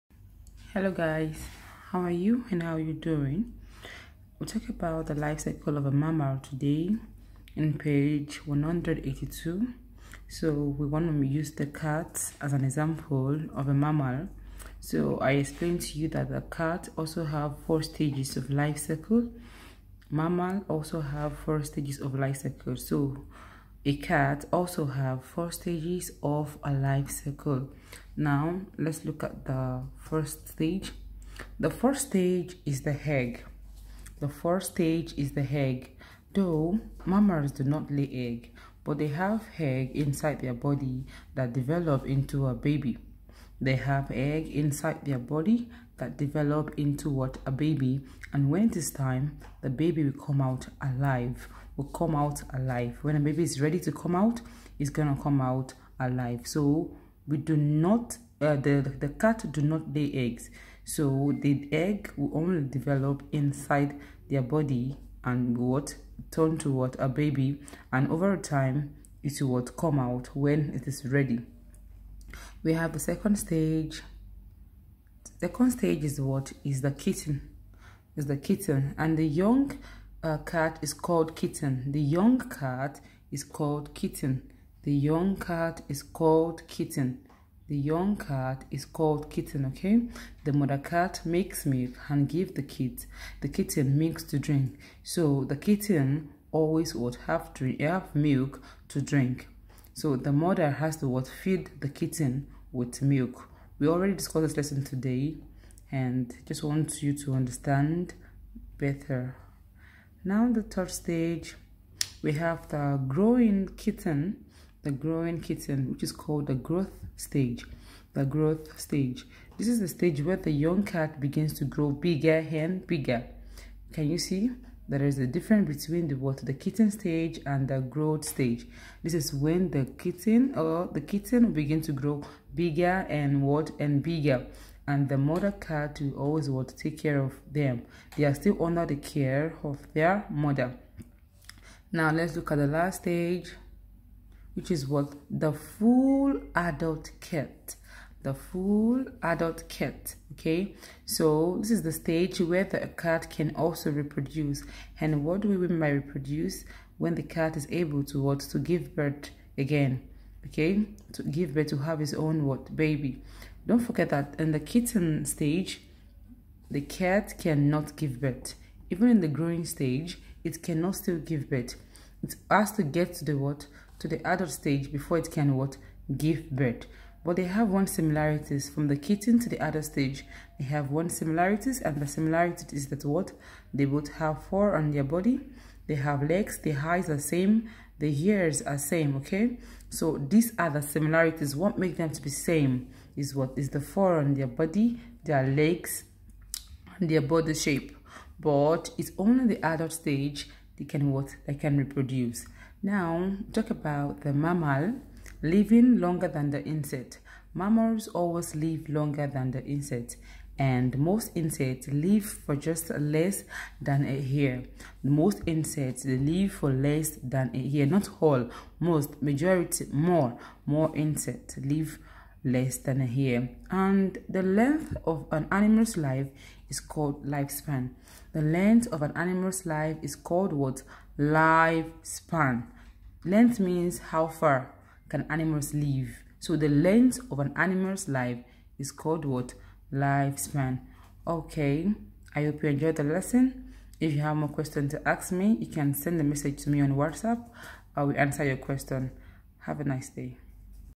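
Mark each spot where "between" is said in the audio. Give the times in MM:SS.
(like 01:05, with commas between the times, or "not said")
02:05.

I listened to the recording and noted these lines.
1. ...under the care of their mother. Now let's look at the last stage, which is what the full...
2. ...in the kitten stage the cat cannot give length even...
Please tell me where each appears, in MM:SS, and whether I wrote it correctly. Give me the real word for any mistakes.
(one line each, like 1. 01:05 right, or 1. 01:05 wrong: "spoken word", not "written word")
1. 02:18 right
2. 02:44 wrong: "birth", not "length".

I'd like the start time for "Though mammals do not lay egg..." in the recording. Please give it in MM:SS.
00:36.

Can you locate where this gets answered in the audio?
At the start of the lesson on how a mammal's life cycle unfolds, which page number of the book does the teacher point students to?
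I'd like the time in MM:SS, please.
00:07.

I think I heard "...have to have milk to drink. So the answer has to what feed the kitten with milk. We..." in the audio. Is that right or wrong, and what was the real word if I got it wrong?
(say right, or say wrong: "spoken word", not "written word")
wrong: "mother", not "answer".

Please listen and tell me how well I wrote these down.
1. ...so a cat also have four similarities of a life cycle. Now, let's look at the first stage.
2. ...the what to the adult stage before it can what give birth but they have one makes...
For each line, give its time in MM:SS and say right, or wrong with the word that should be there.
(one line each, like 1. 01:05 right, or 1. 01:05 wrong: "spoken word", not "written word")
1. 00:22 wrong: "stages", not "similarities"
2. 02:53 wrong: "similarities", not "makes".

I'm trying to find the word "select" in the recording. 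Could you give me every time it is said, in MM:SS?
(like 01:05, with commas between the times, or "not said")
not said.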